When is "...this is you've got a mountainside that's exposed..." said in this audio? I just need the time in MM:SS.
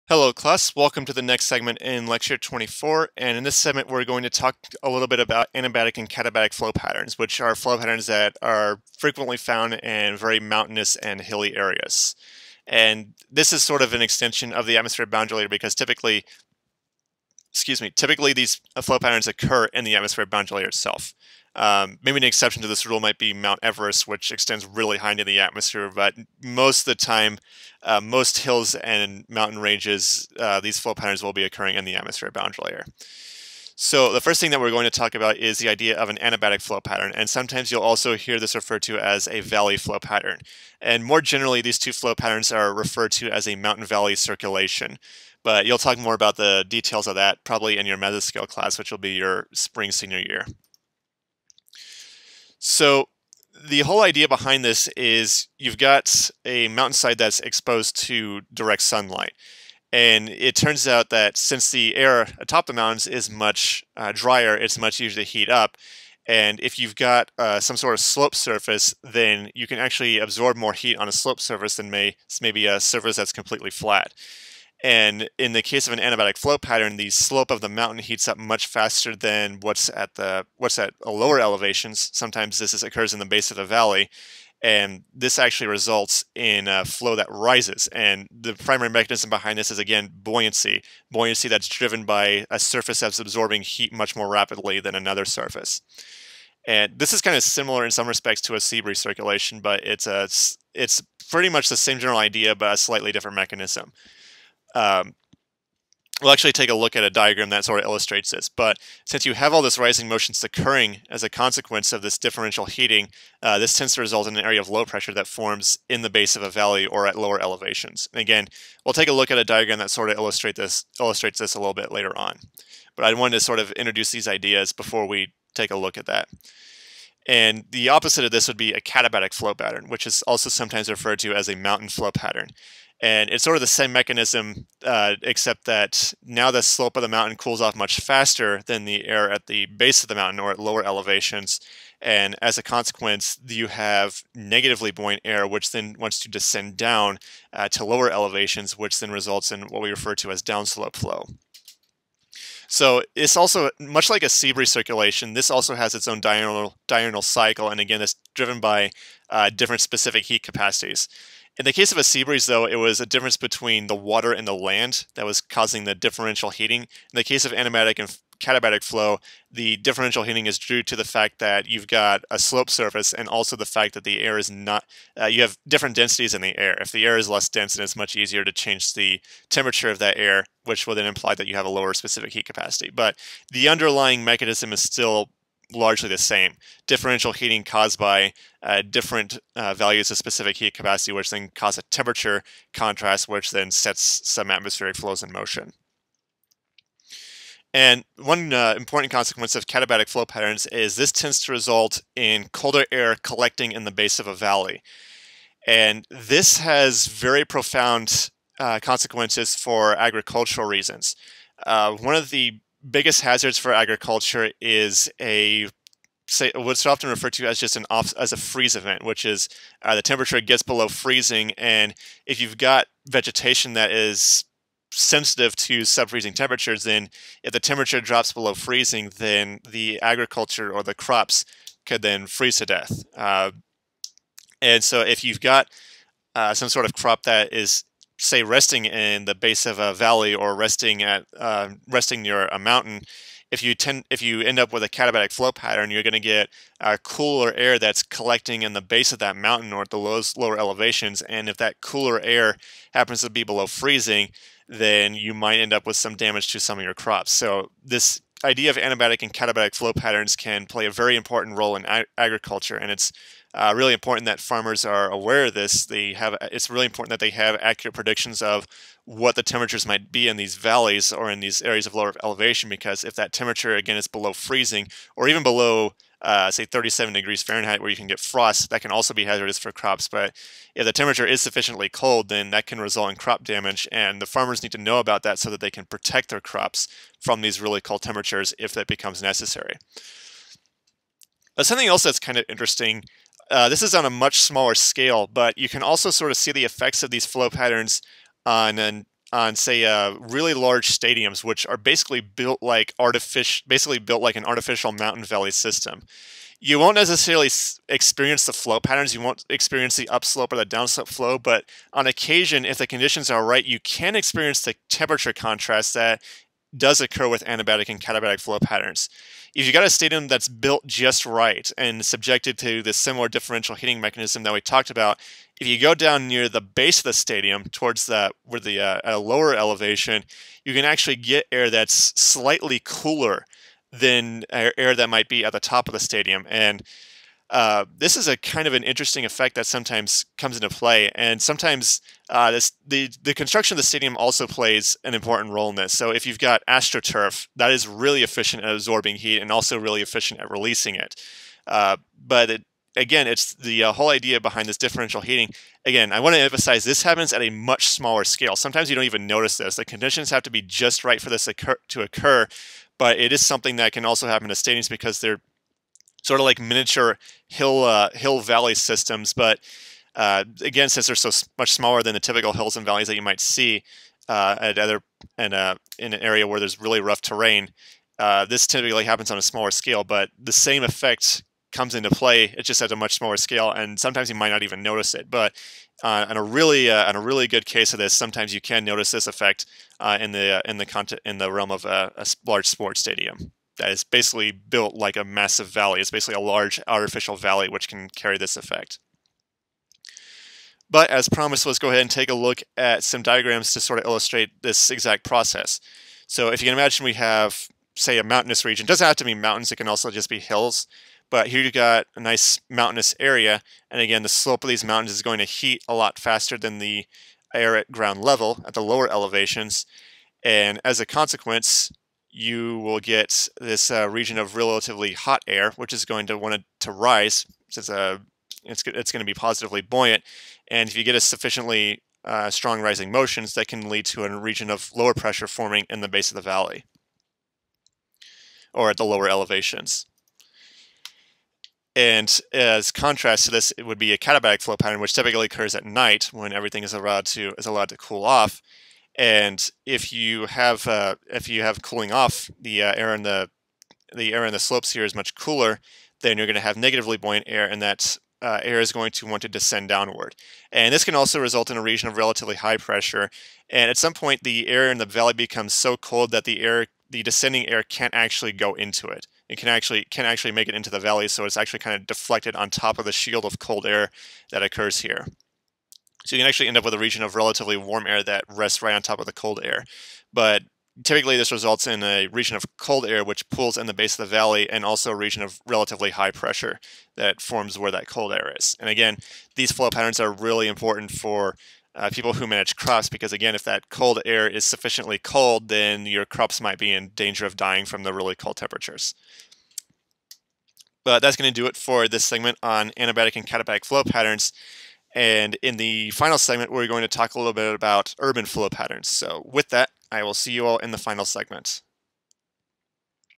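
00:54.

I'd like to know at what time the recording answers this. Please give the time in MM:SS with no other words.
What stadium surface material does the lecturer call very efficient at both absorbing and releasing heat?
05:46.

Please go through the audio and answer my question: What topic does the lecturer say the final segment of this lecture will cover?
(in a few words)
urban flow patterns.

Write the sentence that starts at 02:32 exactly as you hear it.
So it's also much like a sea breeze circulation.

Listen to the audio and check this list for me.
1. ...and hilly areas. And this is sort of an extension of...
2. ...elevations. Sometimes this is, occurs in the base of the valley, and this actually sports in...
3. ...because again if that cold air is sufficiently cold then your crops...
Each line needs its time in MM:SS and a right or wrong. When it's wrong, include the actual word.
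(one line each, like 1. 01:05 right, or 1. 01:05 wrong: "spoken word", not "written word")
1. 00:10 right
2. 01:21 wrong: "results", not "sports"
3. 08:13 right.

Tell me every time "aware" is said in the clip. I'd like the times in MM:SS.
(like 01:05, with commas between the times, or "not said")
04:25.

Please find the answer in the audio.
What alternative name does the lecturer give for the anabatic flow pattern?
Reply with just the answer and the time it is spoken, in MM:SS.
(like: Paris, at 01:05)
valley flow pattern, at 00:39.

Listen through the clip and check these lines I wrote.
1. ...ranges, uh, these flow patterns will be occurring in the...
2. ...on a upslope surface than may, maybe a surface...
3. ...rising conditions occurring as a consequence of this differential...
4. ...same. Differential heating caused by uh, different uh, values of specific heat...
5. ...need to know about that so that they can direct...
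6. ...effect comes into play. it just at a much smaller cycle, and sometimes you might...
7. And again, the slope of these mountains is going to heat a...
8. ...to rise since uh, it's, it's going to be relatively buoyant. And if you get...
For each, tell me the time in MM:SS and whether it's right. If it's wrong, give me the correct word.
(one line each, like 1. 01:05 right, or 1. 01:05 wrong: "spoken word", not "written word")
1. 00:29 right
2. 01:10 wrong: "slope", not "upslope"
3. 01:49 wrong: "motions", not "conditions"
4. 03:06 right
5. 04:44 wrong: "protect", not "direct"
6. 06:20 wrong: "scale", not "cycle"
7. 06:53 right
8. 07:06 wrong: "positively", not "relatively".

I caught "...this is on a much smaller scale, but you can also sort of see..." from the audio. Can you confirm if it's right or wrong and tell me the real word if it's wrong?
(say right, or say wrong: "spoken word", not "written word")
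right.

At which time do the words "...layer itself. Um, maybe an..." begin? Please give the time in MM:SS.
00:20.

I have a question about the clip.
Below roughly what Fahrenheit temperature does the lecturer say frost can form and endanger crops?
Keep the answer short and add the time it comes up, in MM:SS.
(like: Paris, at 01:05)
37 degrees Fahrenheit, at 04:36.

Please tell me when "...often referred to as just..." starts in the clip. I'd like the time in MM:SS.
03:36.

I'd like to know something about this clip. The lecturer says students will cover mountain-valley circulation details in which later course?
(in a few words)
mesoscale class.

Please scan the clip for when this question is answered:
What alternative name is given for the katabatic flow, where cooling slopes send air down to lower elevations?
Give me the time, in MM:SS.
02:11.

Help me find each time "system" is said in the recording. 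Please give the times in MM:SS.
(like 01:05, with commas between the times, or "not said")
05:05, 06:08.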